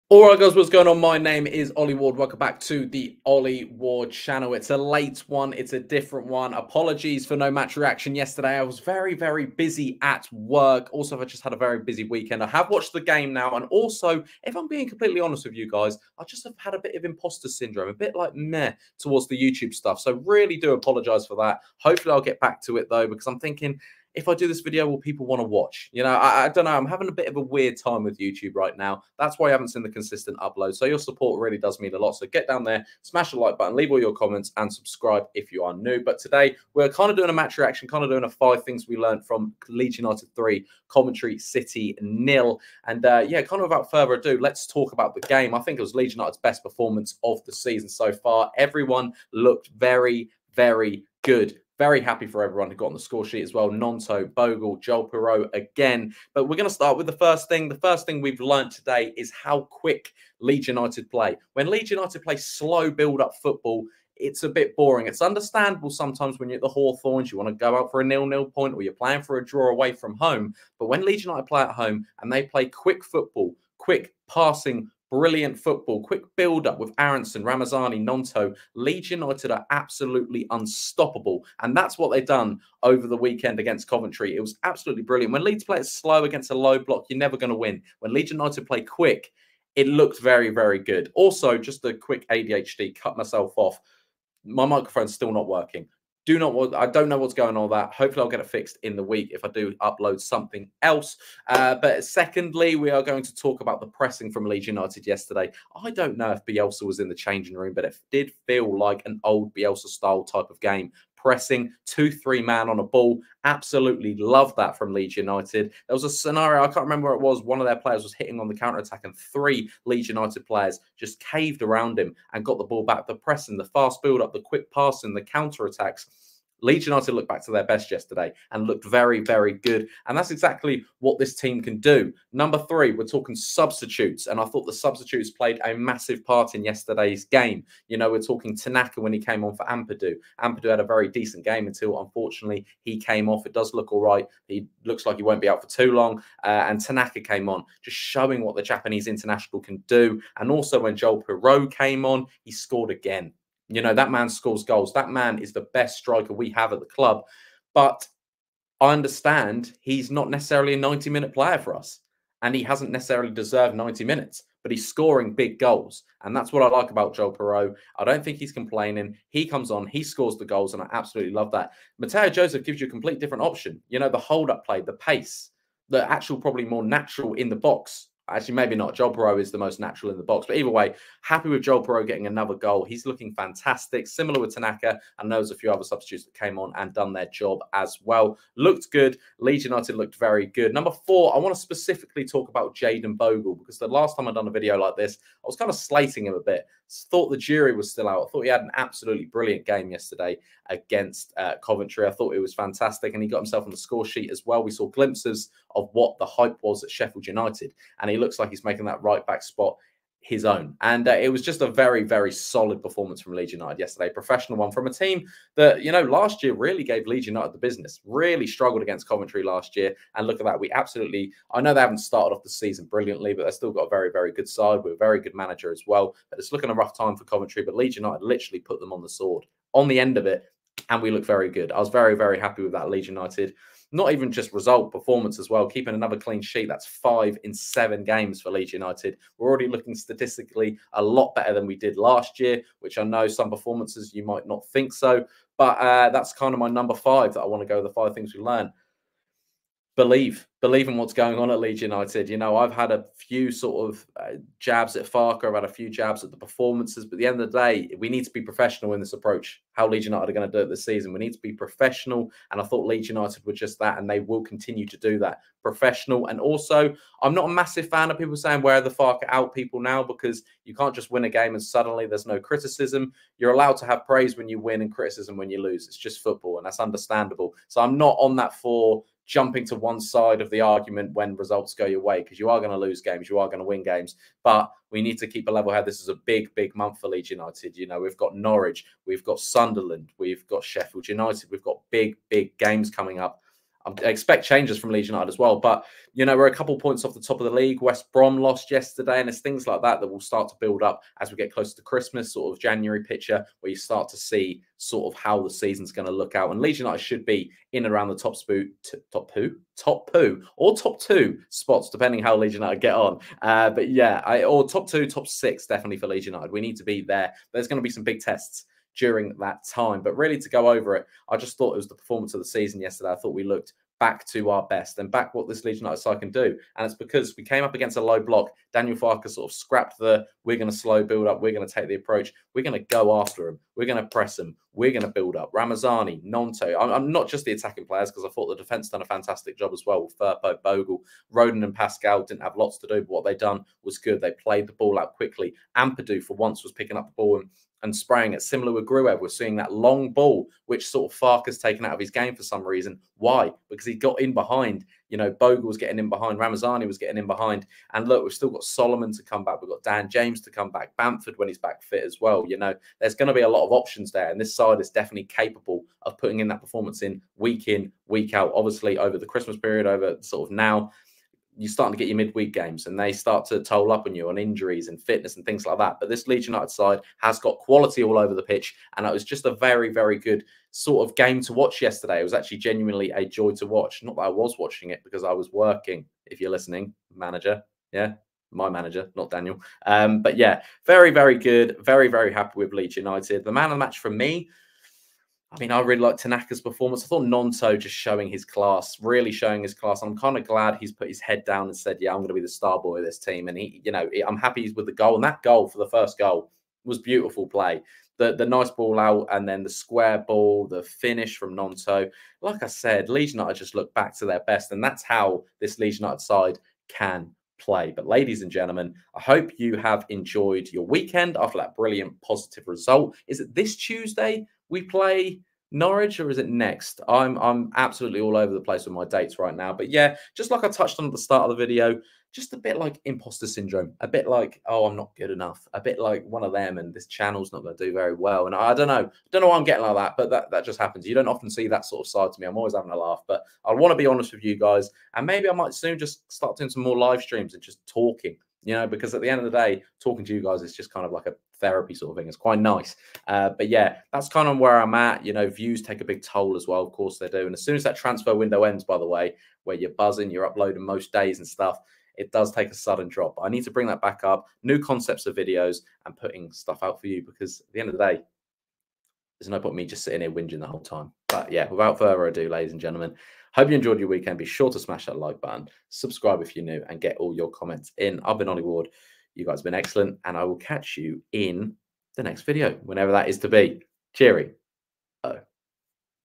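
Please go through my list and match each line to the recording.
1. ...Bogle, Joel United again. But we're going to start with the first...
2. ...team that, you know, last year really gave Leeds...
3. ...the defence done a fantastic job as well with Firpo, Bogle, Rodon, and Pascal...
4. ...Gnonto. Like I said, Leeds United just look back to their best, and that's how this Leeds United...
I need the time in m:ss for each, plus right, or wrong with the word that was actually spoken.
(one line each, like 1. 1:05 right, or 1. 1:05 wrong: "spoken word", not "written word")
1. 0:54 wrong: "Piroe", not "United"
2. 3:34 right
3. 5:38 right
4. 6:51 right.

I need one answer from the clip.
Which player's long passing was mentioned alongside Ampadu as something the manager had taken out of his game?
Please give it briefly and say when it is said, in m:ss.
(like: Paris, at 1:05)
Gruev, at 5:48.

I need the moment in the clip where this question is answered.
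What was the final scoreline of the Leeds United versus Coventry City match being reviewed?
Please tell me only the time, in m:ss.
0:40.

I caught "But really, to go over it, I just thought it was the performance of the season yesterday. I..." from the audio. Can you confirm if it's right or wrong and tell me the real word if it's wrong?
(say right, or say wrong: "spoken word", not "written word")
right.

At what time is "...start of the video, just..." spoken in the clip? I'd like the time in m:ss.
7:11.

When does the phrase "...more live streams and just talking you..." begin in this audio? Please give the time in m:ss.
7:26.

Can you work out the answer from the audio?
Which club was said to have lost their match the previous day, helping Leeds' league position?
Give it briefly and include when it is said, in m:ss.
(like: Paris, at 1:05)
West Brom, at 4:57.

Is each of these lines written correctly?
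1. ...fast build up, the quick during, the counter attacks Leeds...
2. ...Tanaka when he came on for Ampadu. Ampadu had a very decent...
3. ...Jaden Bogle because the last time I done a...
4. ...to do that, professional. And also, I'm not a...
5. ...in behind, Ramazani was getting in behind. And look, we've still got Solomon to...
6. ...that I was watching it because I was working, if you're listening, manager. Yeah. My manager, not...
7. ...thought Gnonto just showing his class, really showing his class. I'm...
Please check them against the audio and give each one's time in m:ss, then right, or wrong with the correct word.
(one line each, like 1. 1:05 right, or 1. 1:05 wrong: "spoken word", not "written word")
1. 2:03 wrong: "passing", not "during"
2. 2:18 right
3. 3:12 right
4. 4:24 right
5. 5:55 right
6. 6:24 right
7. 6:37 right.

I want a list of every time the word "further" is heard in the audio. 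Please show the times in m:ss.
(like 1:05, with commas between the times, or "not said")
0:43, 7:51.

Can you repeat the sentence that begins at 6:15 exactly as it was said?
But this Leeds United side has got quality all over the pitch.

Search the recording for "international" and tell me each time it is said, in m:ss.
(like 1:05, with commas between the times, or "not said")
2:29.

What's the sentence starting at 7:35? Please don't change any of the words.
You know, views take a big toll as well.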